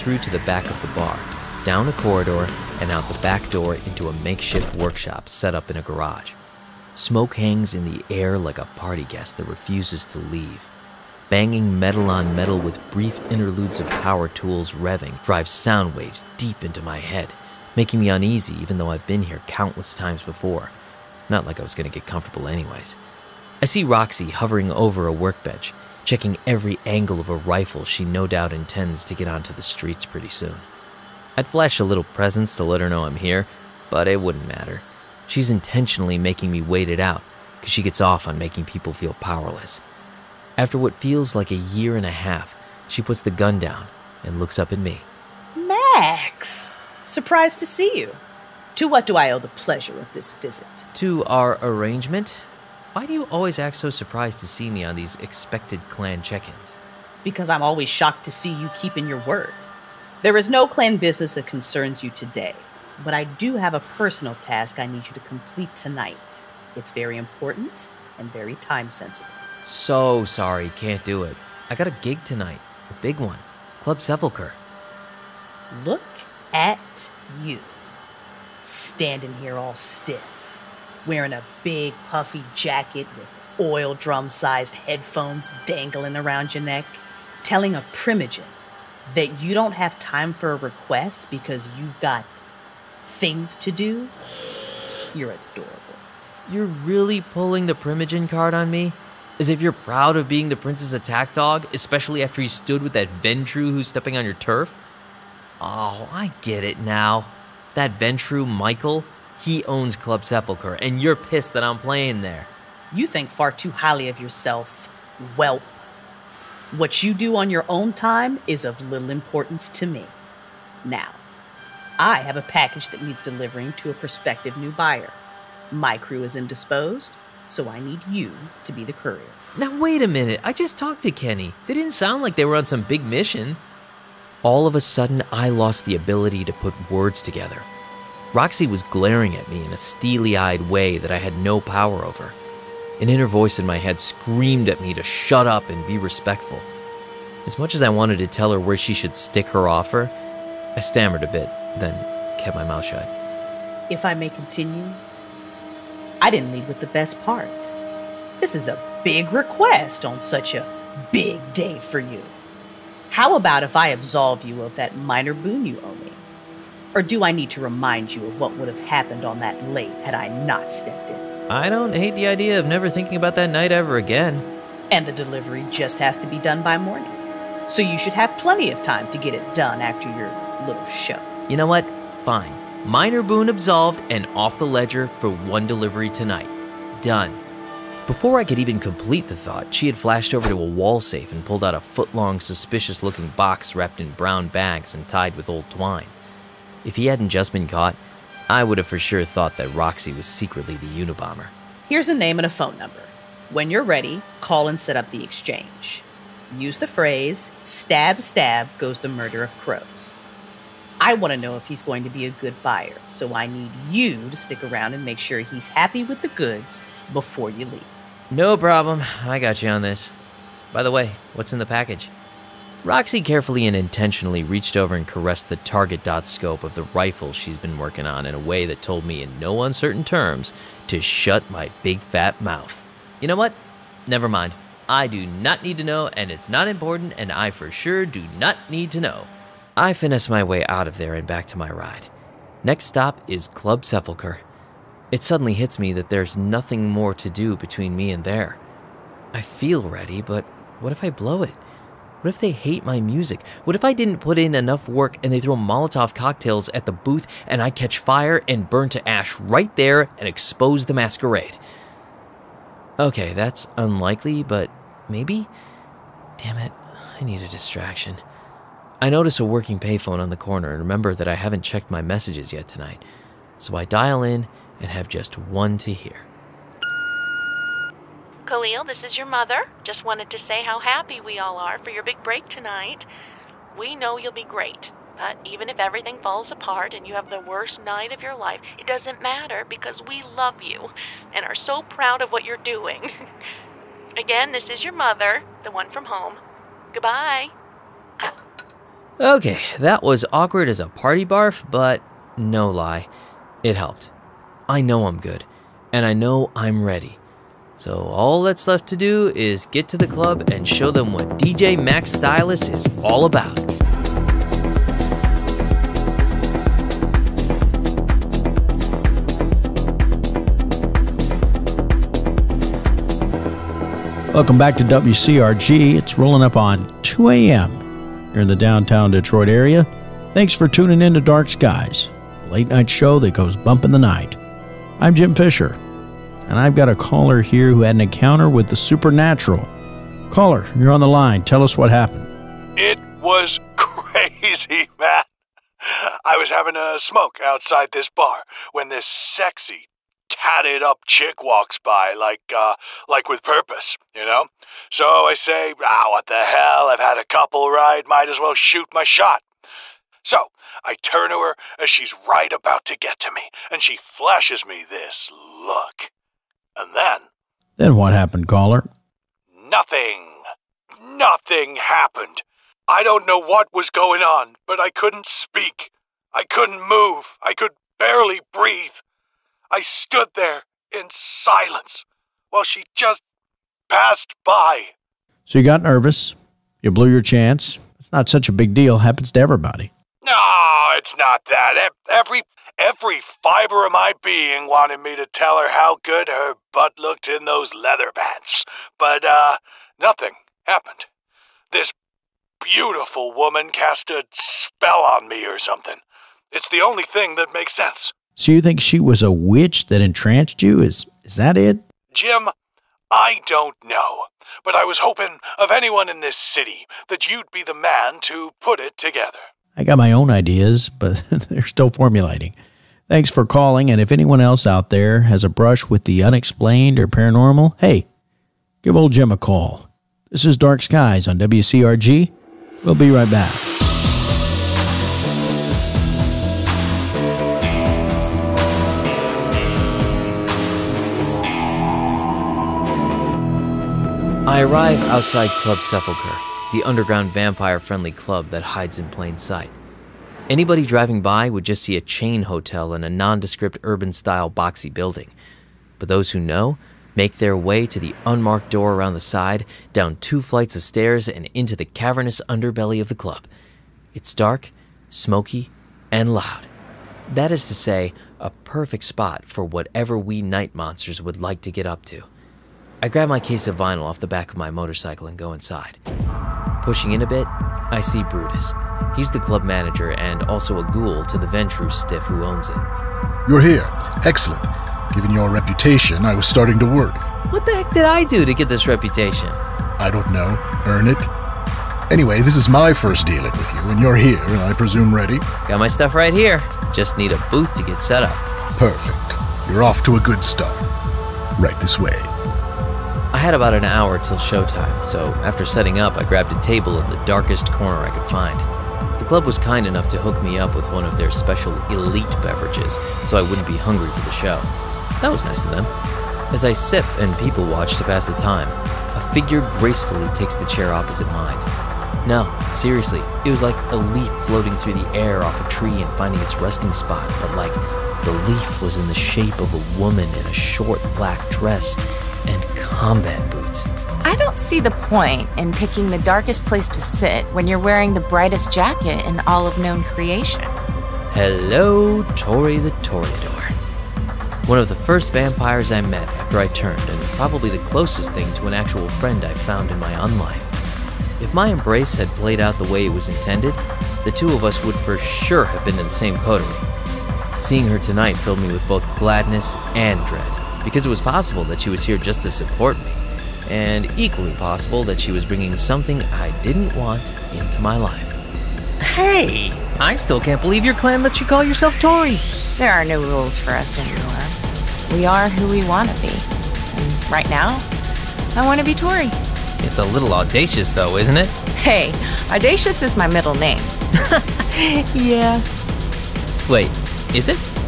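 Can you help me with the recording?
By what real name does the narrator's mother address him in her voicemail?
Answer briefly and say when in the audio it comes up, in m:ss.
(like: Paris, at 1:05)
Khalil, at 4:38.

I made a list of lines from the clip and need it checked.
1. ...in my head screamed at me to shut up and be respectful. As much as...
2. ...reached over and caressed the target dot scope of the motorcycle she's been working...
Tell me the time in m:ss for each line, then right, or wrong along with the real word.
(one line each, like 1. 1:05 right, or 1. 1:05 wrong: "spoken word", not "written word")
1. 2:23 right
2. 3:44 wrong: "rifle", not "motorcycle".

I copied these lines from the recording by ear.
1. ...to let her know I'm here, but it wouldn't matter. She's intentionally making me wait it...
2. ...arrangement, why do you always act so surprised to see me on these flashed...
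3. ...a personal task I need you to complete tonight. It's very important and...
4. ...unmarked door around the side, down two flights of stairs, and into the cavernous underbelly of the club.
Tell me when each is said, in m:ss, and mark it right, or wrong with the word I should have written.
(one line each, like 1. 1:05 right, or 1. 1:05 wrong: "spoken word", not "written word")
1. 0:32 right
2. 0:51 wrong: "expected", not "flashed"
3. 1:03 right
4. 7:38 right.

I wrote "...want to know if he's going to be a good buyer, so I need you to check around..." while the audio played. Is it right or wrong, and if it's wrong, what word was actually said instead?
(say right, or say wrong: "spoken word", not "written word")
wrong: "stick", not "check".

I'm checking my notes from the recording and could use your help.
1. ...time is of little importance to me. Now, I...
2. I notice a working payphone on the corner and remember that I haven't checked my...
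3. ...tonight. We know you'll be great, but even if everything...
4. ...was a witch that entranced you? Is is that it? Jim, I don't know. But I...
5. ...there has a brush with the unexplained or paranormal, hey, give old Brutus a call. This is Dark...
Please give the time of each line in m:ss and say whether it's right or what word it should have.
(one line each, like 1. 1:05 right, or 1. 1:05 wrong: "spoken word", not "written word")
1. 1:57 right
2. 4:28 right
3. 4:42 right
4. 6:48 right
5. 7:04 wrong: "Jim", not "Brutus".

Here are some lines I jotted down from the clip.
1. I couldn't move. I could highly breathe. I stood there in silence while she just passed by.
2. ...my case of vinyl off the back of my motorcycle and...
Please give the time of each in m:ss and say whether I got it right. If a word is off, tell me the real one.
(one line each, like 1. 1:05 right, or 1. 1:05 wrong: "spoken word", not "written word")
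1. 6:16 wrong: "barely", not "highly"
2. 7:53 right.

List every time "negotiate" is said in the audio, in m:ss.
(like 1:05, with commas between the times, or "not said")
not said.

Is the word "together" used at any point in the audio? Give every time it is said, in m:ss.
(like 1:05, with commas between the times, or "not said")
2:17, 6:58.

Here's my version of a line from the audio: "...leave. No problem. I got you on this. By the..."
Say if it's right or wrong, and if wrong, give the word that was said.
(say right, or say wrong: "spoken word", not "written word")
right.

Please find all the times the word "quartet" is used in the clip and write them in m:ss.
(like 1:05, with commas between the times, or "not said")
not said.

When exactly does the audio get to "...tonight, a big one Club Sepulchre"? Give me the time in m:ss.
1:12.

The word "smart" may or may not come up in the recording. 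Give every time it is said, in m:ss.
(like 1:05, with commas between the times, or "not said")
not said.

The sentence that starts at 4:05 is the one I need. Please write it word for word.
It suddenly hits me that there's nothing more to do between me and there.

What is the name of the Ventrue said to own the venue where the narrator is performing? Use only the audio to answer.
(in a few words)
Michael.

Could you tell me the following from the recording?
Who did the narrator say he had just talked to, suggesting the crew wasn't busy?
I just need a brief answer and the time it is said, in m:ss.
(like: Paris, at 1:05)
Kenny, at 2:11.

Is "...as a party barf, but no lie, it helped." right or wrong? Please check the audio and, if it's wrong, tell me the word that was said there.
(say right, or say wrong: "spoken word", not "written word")
right.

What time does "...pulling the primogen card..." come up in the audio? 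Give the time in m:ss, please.
1:37.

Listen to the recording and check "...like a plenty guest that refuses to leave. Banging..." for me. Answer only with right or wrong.
wrong.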